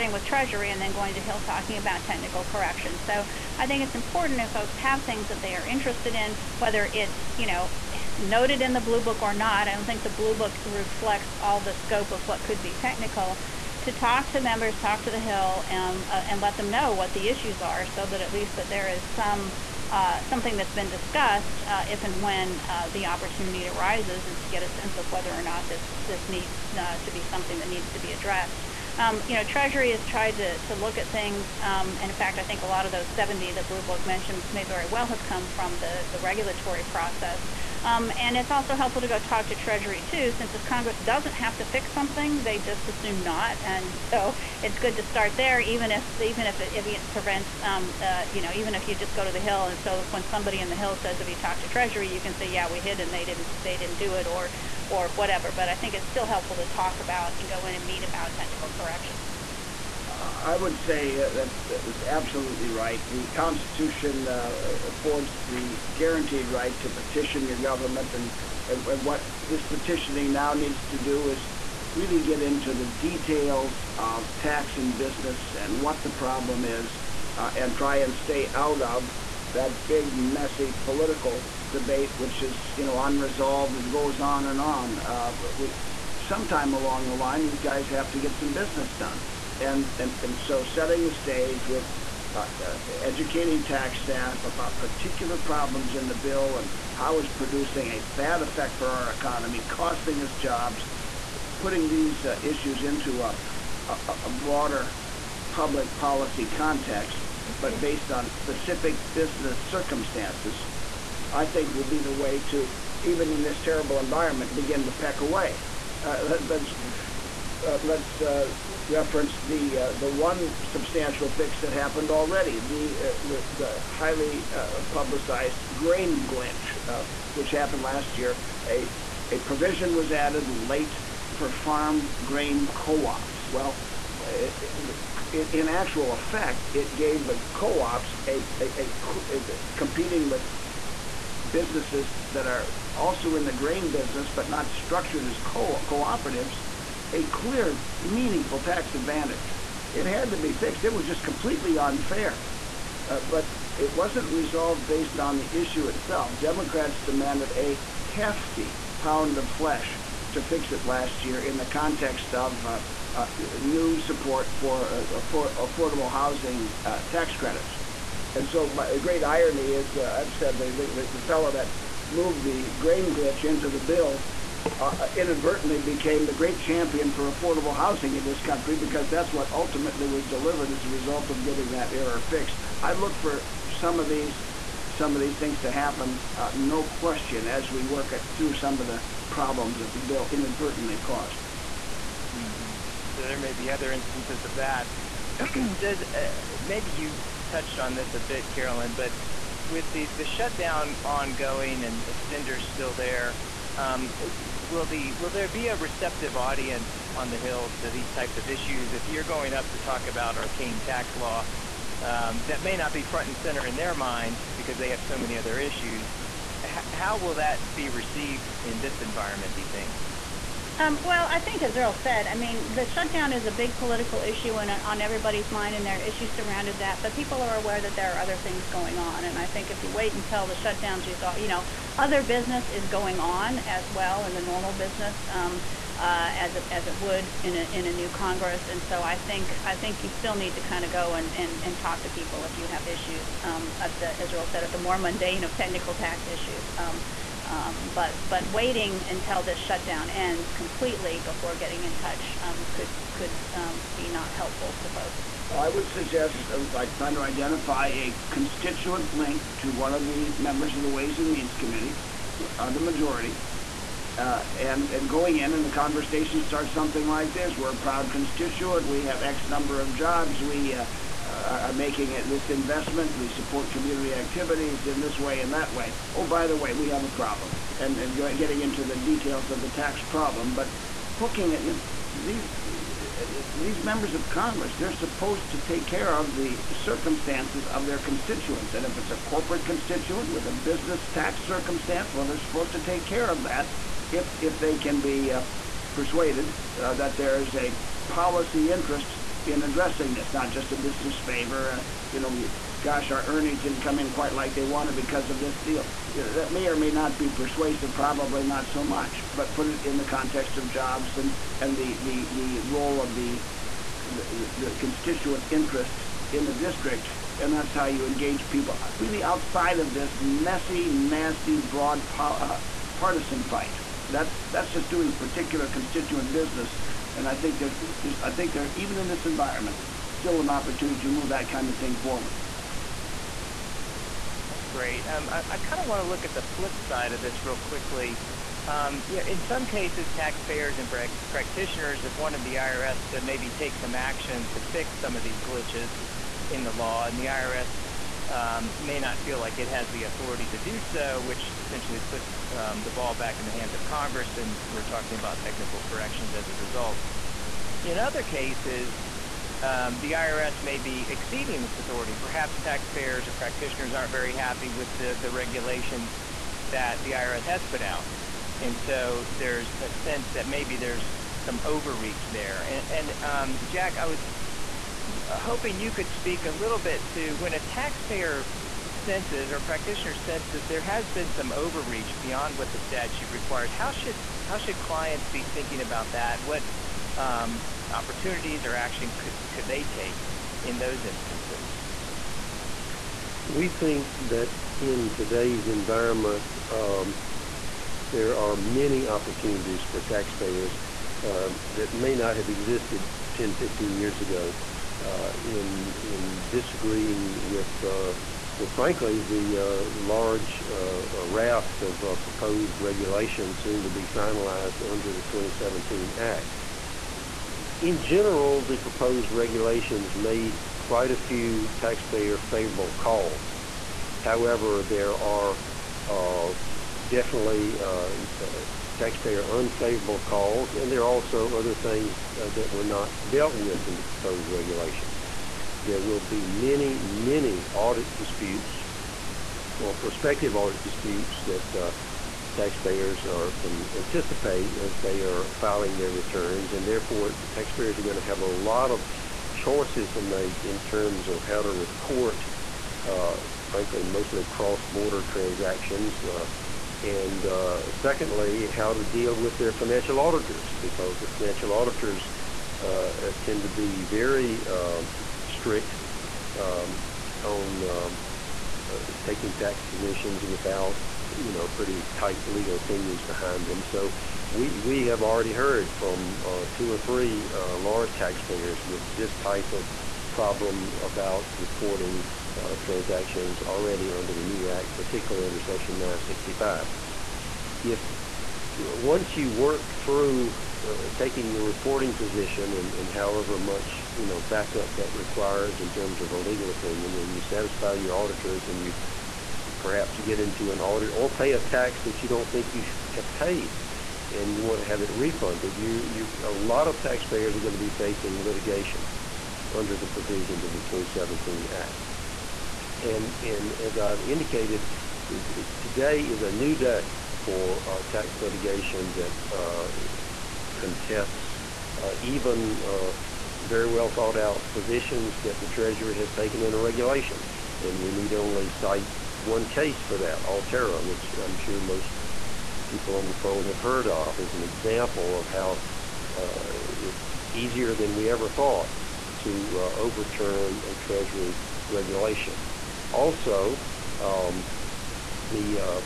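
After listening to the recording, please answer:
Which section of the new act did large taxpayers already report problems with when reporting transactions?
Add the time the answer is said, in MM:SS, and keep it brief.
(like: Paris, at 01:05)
Section 965, at 08:05.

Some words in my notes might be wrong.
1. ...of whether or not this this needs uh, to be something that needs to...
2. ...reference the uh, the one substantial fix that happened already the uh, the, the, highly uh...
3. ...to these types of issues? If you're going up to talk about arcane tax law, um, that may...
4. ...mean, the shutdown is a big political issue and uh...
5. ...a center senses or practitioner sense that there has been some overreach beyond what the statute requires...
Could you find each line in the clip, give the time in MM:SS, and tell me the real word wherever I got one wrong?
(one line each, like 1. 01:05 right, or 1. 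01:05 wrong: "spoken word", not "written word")
1. 00:24 right
2. 01:58 right
3. 03:27 right
4. 03:42 right
5. 06:17 wrong: "taxpayer", not "center".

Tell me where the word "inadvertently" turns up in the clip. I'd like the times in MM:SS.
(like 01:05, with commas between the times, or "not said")
02:55, 03:10.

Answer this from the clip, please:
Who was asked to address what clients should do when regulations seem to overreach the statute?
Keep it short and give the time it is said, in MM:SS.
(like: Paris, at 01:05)
Jack, at 06:13.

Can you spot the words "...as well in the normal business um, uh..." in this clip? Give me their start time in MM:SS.
03:53.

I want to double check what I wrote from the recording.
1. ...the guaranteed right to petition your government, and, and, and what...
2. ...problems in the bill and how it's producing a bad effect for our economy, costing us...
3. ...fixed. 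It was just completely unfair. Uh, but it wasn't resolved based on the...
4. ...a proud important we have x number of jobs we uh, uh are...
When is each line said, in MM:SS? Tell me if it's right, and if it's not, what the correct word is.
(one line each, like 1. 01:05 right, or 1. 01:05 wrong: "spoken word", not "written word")
1. 01:05 right
2. 01:35 right
3. 02:30 right
4. 04:27 wrong: "constituent", not "important".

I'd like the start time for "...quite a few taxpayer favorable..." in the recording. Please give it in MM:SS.
07:00.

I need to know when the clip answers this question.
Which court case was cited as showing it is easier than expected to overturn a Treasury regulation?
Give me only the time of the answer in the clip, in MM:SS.
08:50.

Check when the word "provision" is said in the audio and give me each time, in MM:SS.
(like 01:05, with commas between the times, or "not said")
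02:09, 08:30.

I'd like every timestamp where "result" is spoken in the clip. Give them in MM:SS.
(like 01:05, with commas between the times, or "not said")
03:00, 05:56.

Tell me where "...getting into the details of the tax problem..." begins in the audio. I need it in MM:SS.
04:38.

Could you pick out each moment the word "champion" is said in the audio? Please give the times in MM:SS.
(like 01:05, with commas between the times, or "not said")
02:56.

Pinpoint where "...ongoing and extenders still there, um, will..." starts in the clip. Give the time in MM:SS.
03:21.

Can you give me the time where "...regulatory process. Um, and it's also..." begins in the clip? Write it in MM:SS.
00:36.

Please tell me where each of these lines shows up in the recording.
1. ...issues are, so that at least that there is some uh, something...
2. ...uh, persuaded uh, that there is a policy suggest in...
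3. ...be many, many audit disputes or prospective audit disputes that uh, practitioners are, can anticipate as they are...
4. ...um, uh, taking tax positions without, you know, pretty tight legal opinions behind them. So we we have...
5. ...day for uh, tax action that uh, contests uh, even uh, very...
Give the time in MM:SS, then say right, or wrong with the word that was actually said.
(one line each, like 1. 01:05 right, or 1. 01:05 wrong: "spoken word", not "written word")
1. 00:17 right
2. 04:55 wrong: "interest", not "suggest"
3. 07:16 wrong: "taxpayers", not "practitioners"
4. 07:47 right
5. 08:36 wrong: "litigation", not "action".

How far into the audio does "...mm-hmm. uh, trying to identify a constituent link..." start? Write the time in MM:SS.
04:16.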